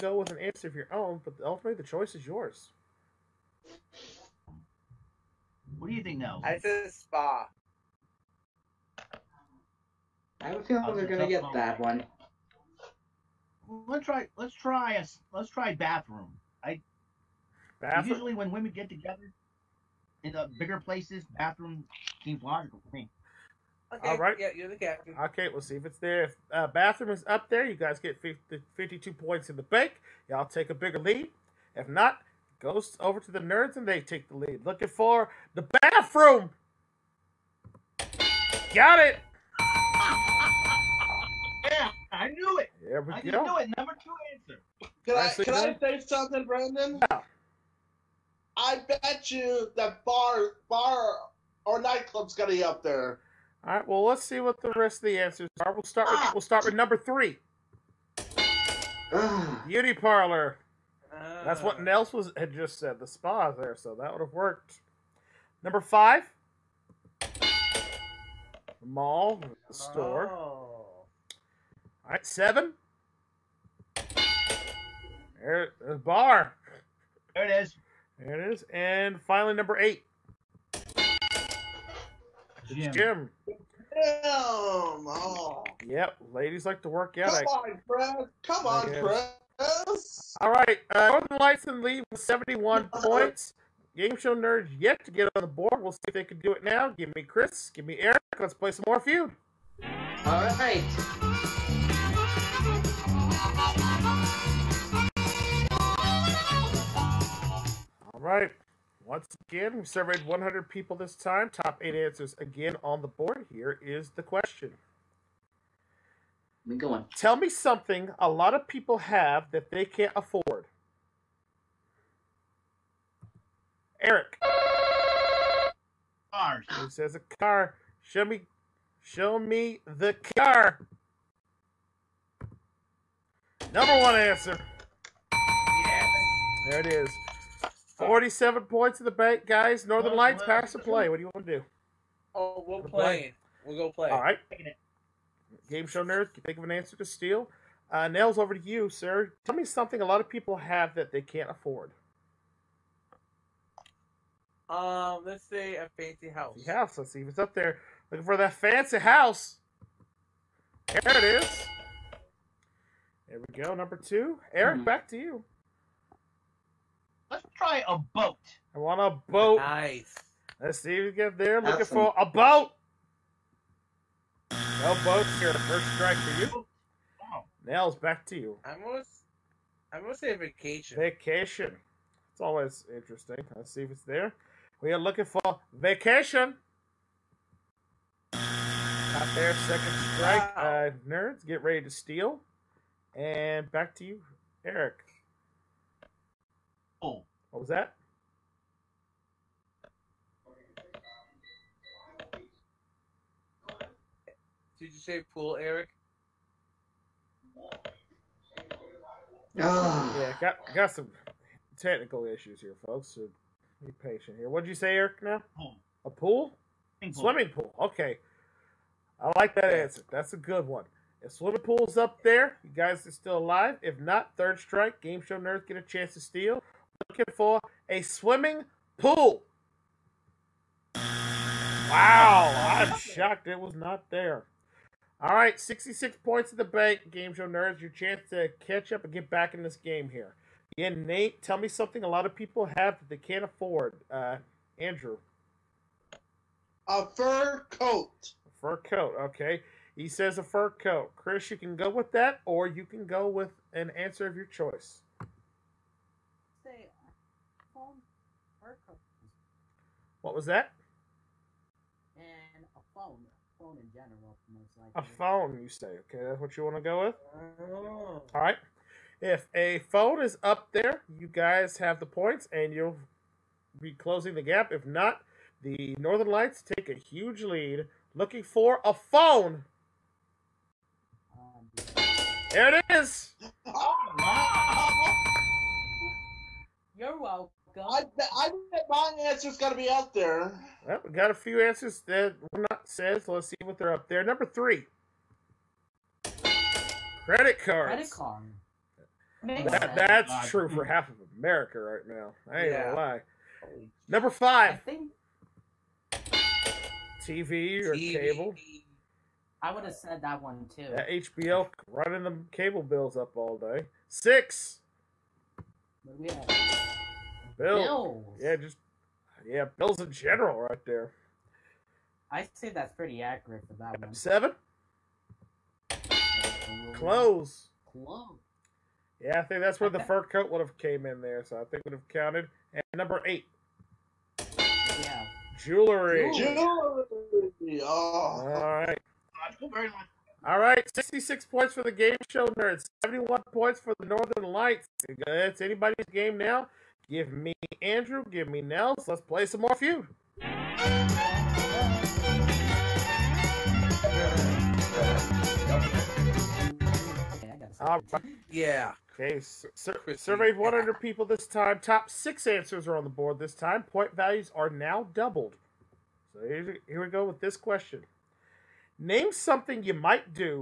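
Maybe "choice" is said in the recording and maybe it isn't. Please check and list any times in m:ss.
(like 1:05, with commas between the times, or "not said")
0:01, 4:14.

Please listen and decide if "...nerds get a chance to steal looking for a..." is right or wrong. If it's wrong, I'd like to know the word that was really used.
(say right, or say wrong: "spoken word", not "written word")
right.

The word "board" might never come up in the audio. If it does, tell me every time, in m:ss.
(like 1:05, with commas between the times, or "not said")
1:35, 1:53, 6:03.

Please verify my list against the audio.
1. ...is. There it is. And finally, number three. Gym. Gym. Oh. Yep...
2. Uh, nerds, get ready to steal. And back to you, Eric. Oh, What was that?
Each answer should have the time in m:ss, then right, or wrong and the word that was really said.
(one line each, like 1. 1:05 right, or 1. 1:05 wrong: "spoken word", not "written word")
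1. 1:17 wrong: "eight", not "three"
2. 3:10 right.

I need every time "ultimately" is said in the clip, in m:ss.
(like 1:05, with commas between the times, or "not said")
0:01.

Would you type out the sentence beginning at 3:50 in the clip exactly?
Wow, I'm shocked it was not there.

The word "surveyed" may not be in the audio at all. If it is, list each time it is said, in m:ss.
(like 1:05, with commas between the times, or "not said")
1:49, 6:00.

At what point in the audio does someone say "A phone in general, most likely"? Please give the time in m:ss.
4:23.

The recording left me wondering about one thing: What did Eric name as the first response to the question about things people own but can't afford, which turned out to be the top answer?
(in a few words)
Cars.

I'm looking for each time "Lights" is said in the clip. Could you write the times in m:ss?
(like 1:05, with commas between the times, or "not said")
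1:31, 2:20, 4:36, 5:44.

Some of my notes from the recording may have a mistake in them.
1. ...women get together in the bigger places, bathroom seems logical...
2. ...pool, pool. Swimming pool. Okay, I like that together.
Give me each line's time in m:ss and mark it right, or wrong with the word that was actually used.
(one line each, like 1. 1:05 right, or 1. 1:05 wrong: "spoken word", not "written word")
1. 0:18 right
2. 3:36 wrong: "answer", not "together".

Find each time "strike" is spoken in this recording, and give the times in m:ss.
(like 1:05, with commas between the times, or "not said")
2:55, 3:10, 3:44.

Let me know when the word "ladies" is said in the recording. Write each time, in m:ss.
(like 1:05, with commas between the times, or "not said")
1:26.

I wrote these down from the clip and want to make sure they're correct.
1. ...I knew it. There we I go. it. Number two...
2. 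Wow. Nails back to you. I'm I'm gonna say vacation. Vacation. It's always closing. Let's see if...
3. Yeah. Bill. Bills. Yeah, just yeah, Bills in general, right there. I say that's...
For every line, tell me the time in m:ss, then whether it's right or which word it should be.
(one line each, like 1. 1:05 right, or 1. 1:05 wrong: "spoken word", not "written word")
1. 0:42 right
2. 2:57 wrong: "interesting", not "closing"
3. 5:16 right.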